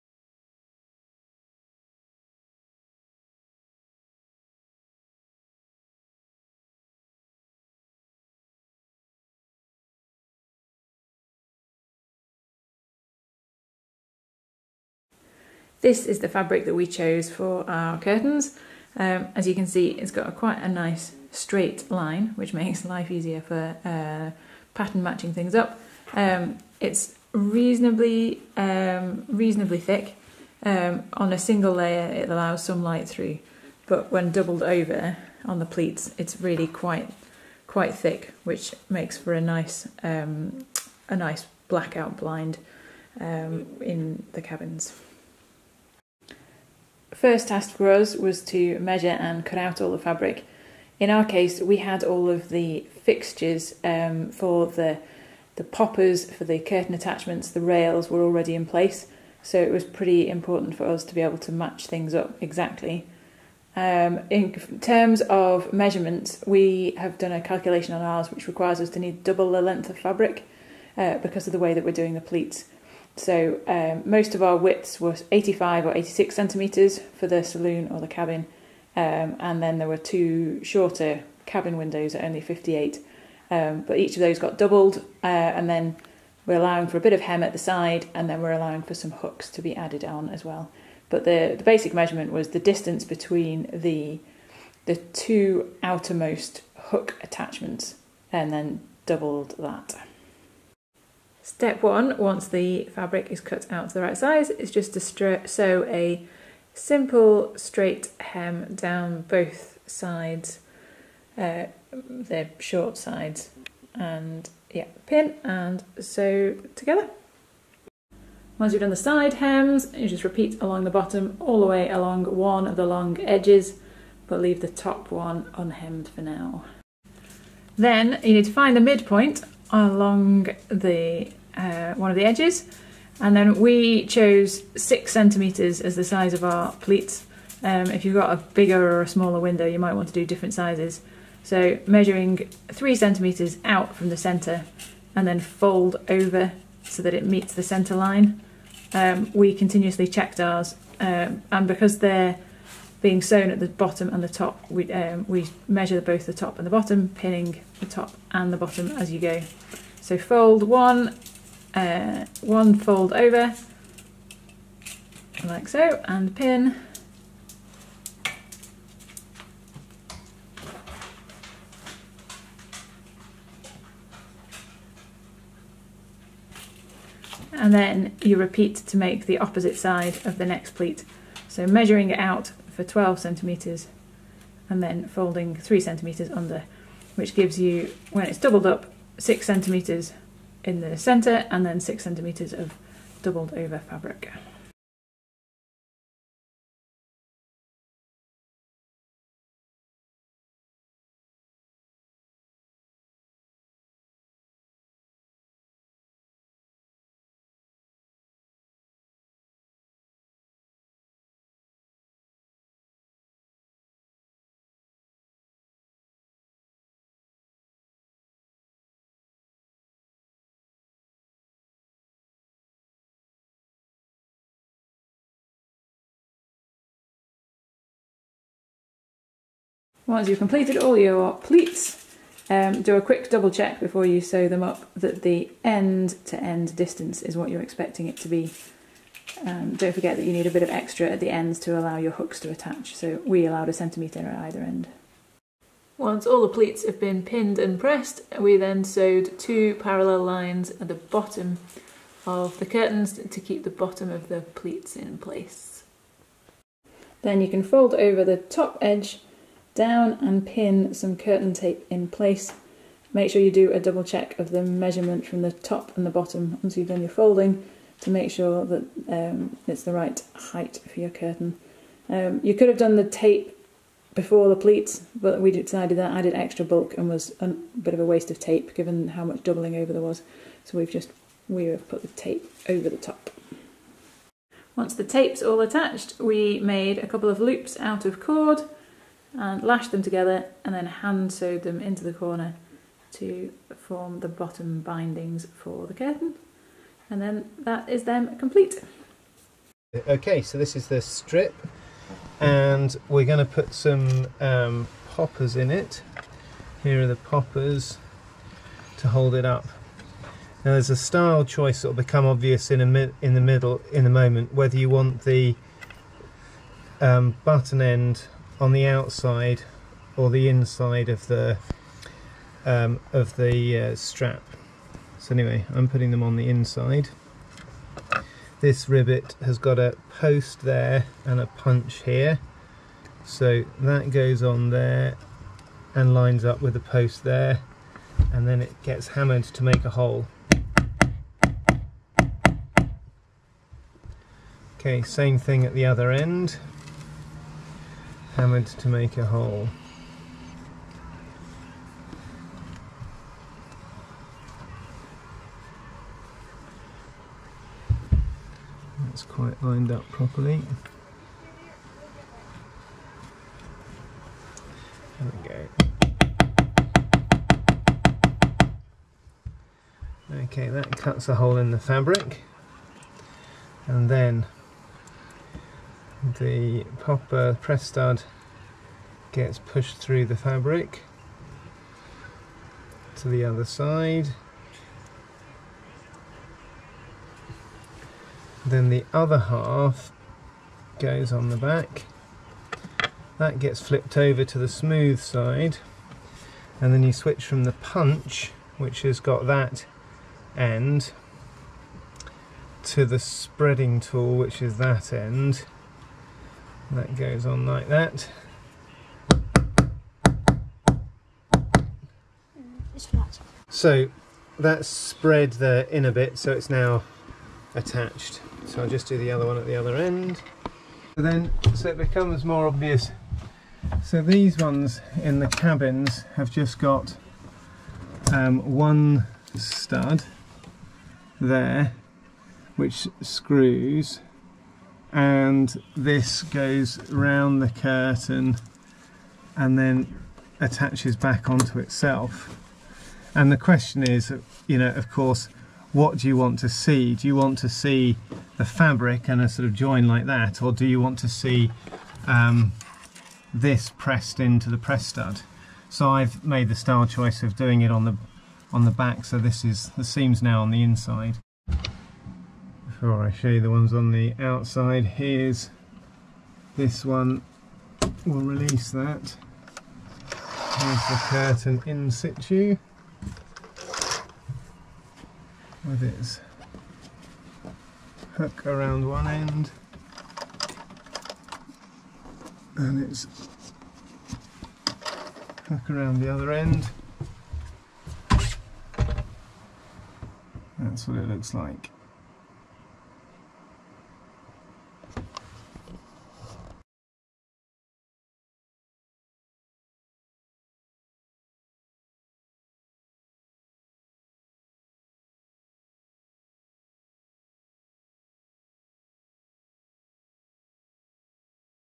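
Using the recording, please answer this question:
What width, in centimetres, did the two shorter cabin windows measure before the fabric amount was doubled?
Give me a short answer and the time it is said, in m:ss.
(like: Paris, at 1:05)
58, at 1:22.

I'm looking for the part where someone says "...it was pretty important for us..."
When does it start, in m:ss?
0:59.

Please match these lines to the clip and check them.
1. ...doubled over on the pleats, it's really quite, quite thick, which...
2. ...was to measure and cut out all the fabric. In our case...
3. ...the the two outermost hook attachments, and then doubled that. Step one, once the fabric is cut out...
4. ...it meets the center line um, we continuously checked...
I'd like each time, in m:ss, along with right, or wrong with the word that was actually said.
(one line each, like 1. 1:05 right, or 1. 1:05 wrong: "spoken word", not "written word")
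1. 0:34 right
2. 0:48 right
3. 1:33 right
4. 2:27 right.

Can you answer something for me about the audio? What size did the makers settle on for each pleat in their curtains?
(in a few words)
6 centimeters.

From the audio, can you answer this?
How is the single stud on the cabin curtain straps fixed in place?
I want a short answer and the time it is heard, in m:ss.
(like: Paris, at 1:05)
screws, at 7:13.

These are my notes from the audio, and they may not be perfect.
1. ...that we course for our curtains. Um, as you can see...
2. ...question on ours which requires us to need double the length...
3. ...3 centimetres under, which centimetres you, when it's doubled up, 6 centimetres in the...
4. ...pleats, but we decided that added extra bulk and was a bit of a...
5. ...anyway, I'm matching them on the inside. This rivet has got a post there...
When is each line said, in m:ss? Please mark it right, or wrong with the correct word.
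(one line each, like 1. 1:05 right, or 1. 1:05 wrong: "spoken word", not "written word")
1. 0:16 wrong: "chose", not "course"
2. 1:07 wrong: "calculation", not "question"
3. 3:05 wrong: "gives", not "centimetres"
4. 4:34 right
5. 5:25 wrong: "putting", not "matching".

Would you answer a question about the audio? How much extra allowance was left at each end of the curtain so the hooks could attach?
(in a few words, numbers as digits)
1 centimetre.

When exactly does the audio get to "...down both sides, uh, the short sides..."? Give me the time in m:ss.
1:48.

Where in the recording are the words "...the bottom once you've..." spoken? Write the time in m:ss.
4:26.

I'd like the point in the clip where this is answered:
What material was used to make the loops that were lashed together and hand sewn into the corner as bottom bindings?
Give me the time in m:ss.
4:48.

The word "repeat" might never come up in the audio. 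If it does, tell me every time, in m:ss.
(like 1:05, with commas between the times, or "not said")
2:00, 2:58.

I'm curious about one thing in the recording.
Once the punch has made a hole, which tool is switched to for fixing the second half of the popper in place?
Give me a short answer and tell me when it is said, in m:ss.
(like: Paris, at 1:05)
spreading tool, at 6:43.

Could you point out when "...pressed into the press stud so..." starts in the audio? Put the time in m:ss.
7:33.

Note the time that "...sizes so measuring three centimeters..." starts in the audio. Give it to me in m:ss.
2:20.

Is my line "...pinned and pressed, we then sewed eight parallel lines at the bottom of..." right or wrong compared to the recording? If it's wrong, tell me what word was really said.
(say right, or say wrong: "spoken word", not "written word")
wrong: "two", not "eight".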